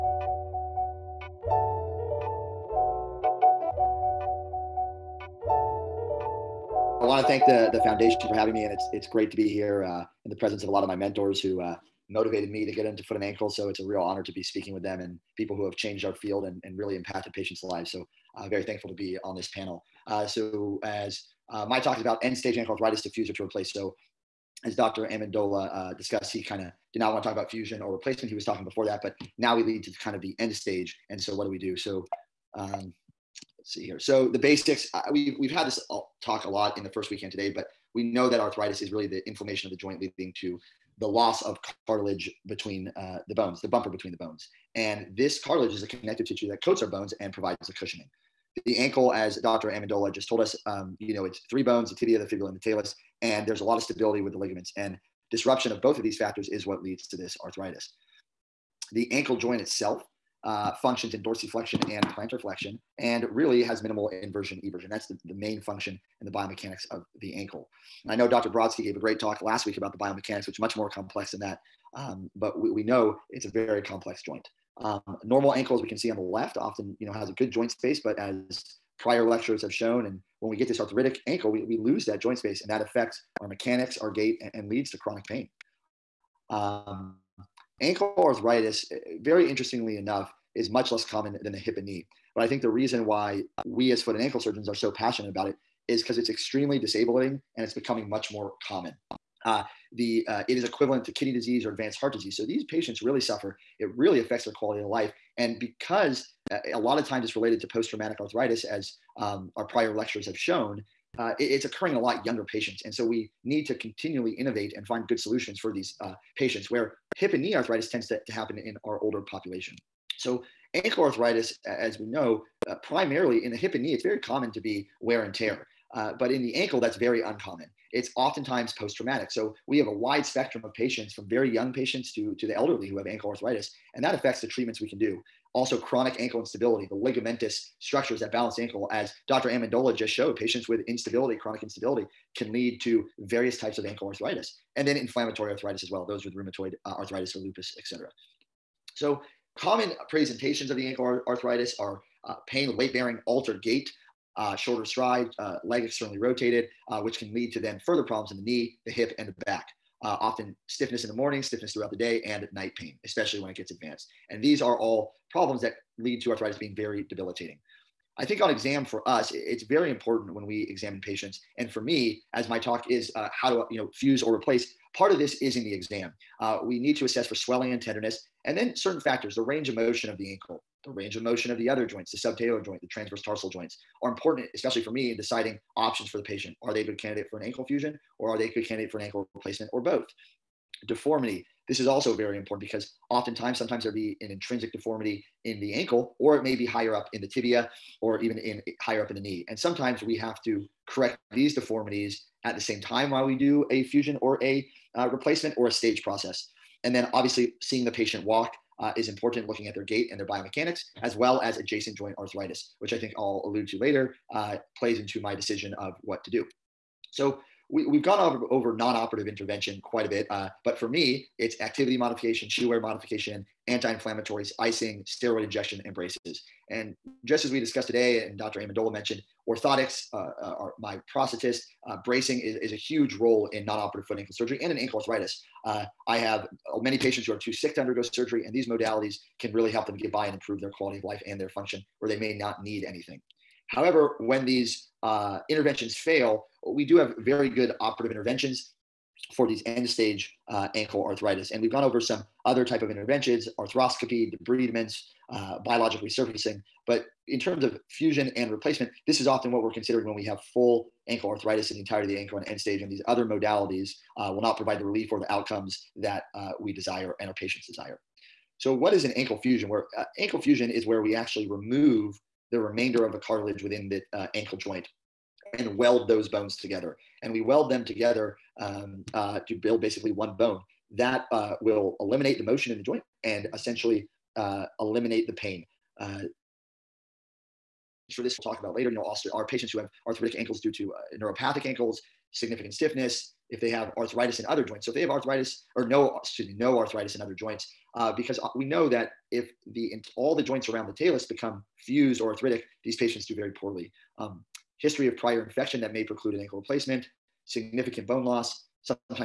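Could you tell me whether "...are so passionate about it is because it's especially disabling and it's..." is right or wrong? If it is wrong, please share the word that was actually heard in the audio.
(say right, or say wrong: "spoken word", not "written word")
wrong: "extremely", not "especially".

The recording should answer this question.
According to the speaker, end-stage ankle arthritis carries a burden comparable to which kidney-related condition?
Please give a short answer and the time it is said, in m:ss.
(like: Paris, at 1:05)
kidney disease, at 1:41.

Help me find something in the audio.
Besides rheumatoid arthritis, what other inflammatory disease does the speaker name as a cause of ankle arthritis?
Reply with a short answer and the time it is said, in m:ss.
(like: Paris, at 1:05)
lupus, at 2:27.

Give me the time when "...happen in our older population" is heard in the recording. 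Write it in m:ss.
1:58.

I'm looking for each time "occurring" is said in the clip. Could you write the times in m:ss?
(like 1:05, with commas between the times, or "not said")
1:51.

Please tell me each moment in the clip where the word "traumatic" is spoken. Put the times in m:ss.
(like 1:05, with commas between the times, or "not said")
1:47, 2:08.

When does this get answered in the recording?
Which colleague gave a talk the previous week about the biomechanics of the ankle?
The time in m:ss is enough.
1:08.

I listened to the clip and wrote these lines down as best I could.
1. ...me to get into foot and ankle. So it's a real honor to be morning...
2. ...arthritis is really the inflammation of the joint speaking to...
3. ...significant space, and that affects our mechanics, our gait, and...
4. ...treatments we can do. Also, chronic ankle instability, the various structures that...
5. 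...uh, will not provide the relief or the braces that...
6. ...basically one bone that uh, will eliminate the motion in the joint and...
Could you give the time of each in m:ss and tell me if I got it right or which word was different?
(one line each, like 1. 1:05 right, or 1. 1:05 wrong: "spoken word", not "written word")
1. 0:12 wrong: "speaking", not "morning"
2. 0:38 wrong: "leading", not "speaking"
3. 1:22 wrong: "joint", not "significant"
4. 2:14 wrong: "ligamentous", not "various"
5. 4:24 wrong: "outcomes", not "braces"
6. 4:39 right.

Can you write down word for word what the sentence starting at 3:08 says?
or are they a good candidate for an ankle replacement or both?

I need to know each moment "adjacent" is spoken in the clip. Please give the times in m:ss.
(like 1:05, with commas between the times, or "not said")
3:31.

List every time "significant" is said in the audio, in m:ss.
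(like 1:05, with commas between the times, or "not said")
4:52, 5:07.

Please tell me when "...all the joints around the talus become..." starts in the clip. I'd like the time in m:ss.
5:00.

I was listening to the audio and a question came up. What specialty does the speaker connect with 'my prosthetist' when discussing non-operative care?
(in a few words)
orthotics.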